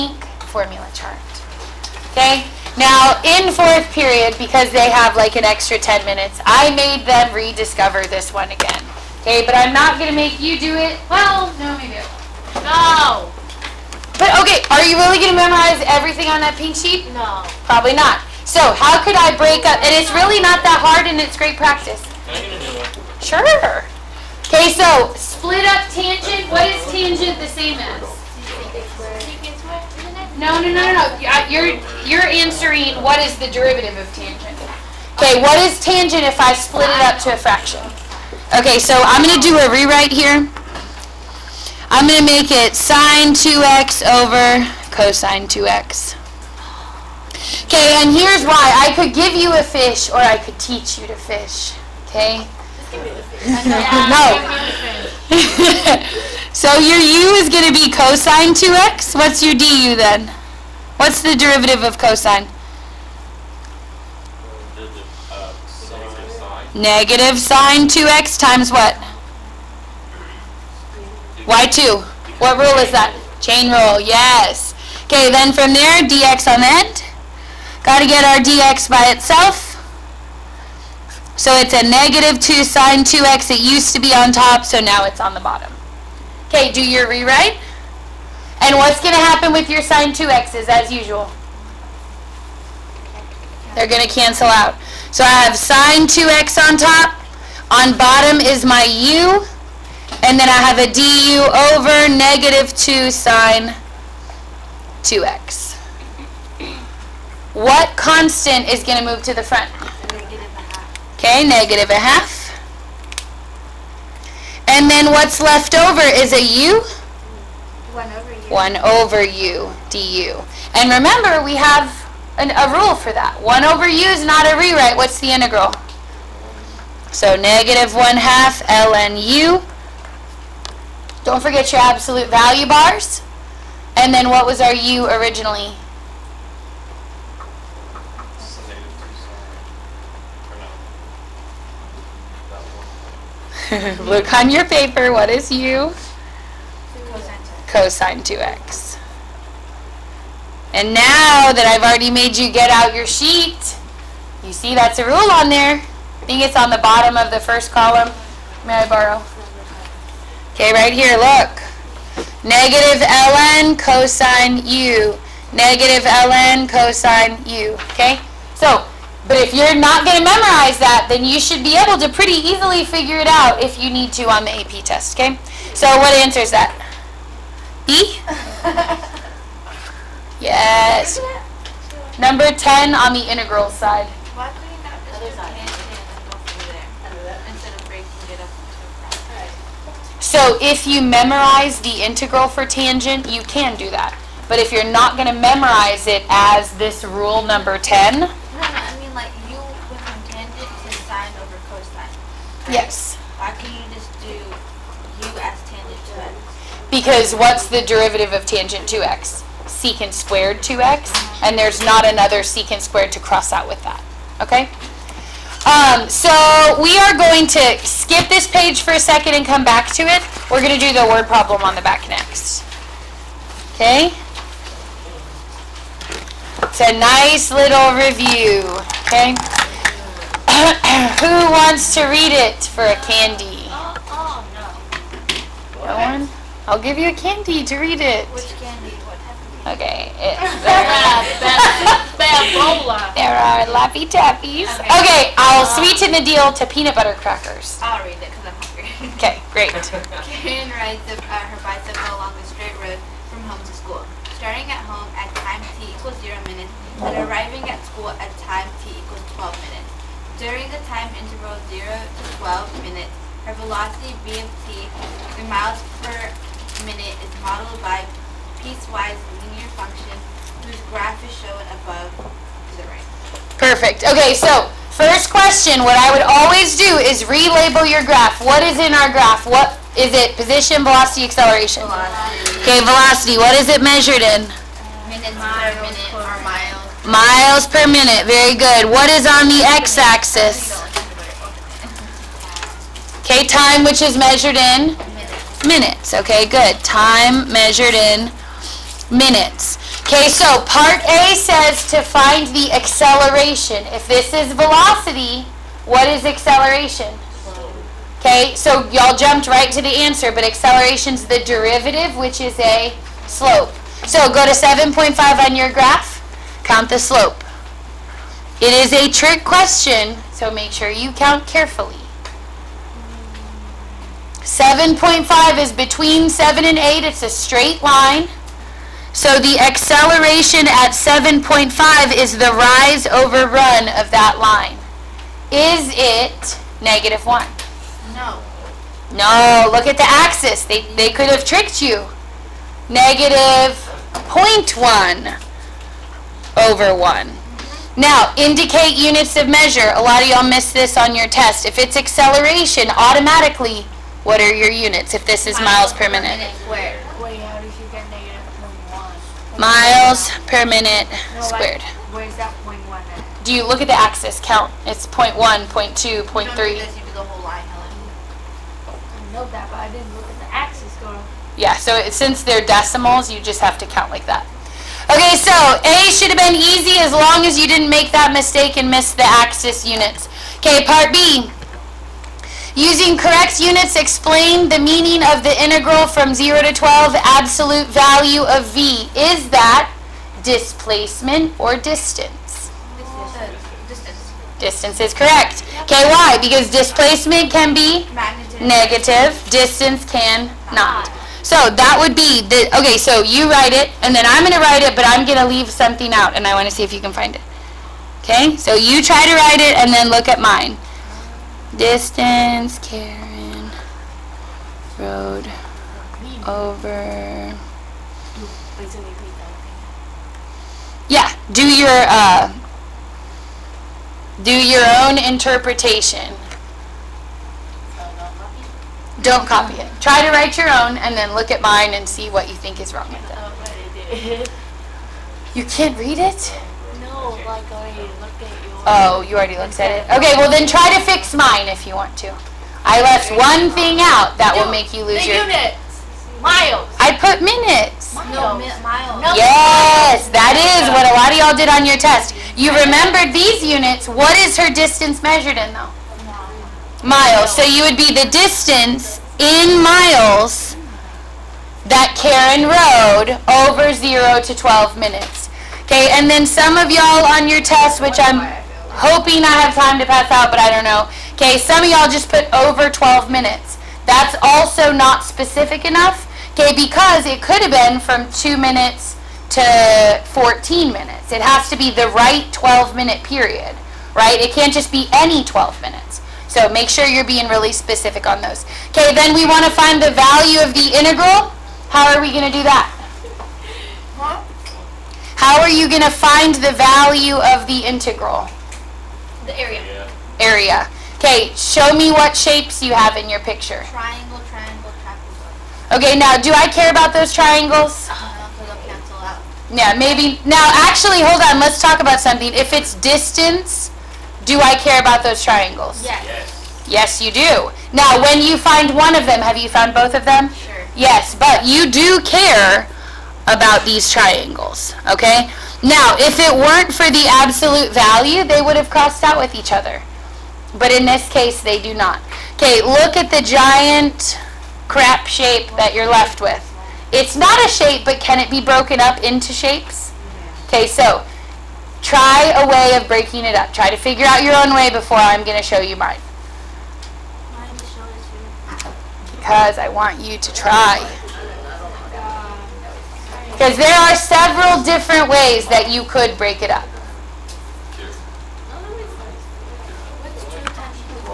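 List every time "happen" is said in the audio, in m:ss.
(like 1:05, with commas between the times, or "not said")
1:29.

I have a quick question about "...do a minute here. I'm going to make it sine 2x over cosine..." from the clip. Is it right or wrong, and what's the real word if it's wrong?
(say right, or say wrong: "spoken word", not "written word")
wrong: "rewrite", not "minute".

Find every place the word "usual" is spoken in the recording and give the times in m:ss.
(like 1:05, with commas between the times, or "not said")
1:30.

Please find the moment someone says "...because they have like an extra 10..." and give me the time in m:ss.
0:04.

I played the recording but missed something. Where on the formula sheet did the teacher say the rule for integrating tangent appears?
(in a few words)
bottom of the first column.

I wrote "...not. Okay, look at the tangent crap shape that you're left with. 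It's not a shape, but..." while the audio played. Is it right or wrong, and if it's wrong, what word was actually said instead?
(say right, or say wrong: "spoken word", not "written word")
wrong: "giant", not "tangent".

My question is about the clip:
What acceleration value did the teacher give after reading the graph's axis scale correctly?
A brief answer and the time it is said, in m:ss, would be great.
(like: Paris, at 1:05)
-0.1, at 5:42.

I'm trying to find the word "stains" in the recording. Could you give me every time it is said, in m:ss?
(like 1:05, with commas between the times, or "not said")
not said.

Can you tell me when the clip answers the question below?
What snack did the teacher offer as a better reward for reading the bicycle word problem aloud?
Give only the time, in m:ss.
4:06.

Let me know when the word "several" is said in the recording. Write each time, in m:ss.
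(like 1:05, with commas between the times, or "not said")
9:14.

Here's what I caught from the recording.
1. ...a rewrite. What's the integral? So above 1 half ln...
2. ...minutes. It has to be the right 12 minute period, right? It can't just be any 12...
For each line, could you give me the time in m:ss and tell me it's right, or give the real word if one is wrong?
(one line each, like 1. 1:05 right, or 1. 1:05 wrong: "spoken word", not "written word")
1. 2:04 wrong: "negative", not "above"
2. 8:00 right.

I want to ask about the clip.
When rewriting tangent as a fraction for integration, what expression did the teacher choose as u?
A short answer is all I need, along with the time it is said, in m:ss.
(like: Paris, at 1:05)
cosine 2x, at 0:56.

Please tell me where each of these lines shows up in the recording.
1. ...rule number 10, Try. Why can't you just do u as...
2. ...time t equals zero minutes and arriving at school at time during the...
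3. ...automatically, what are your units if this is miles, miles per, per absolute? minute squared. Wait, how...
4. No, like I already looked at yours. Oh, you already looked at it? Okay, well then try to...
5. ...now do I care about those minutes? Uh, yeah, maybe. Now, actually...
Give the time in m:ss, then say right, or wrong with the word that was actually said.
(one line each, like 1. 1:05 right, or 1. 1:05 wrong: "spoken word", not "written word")
1. 3:17 wrong: "Yes", not "Try"
2. 4:15 right
3. 5:52 wrong: "minute", not "absolute"
4. 7:17 right
5. 8:26 wrong: "triangles", not "minutes".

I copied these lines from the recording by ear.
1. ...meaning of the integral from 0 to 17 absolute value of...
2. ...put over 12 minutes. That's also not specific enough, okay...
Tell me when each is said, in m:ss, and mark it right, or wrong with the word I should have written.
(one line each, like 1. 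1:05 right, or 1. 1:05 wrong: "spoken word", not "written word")
1. 6:24 wrong: "12", not "17"
2. 7:52 right.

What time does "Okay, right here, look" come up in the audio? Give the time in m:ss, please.
2:40.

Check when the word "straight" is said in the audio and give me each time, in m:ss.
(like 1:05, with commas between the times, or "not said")
4:12, 5:27.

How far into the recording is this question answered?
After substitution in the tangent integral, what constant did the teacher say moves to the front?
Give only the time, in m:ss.
1:51.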